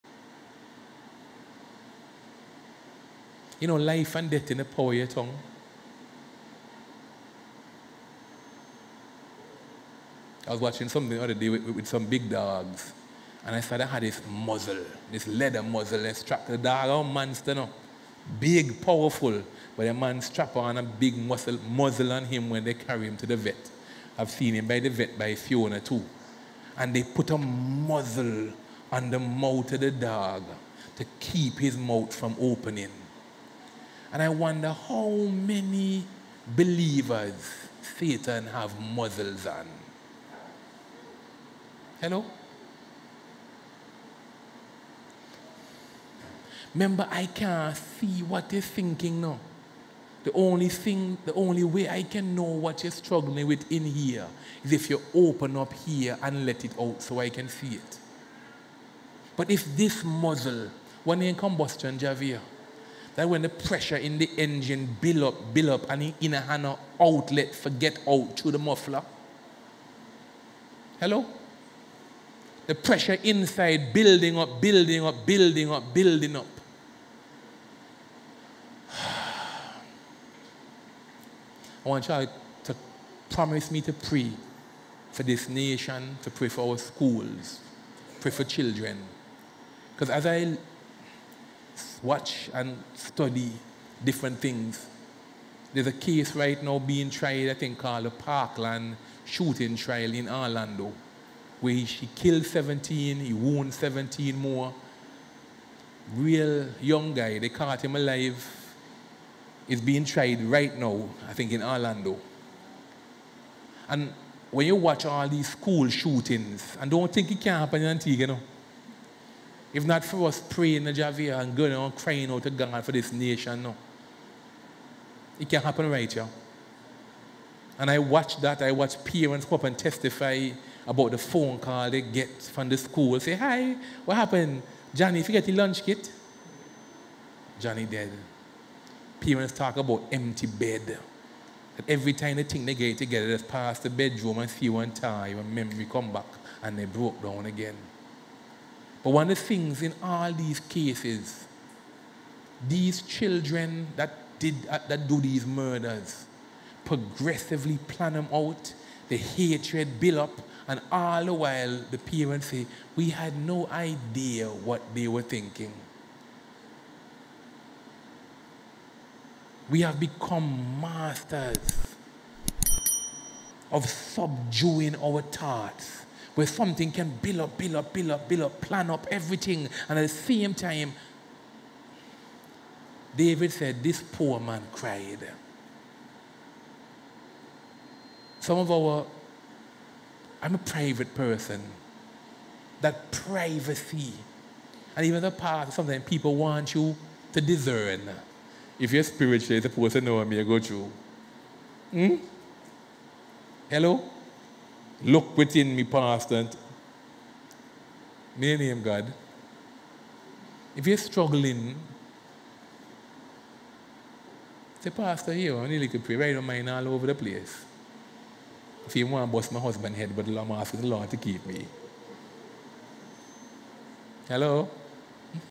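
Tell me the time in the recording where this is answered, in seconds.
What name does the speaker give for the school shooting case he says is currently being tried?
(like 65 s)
98 s.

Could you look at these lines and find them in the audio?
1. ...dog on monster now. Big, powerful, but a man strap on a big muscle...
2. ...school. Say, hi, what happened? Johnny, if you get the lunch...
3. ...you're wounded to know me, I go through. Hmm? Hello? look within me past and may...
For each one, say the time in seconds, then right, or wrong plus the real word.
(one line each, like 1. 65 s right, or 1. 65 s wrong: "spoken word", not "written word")
1. 16 s right
2. 132 s right
3. 199 s wrong: "supposed", not "wounded".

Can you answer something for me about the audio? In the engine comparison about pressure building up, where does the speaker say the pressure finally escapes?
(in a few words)
Muffler.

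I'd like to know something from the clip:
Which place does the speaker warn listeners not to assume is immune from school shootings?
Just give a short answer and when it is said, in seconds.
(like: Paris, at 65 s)
Antigua, at 117 s.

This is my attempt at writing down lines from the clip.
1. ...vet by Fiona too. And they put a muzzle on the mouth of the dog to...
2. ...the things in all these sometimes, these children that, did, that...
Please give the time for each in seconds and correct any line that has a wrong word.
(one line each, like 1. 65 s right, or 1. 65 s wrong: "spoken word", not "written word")
1. 24 s right
2. 149 s wrong: "cases", not "sometimes".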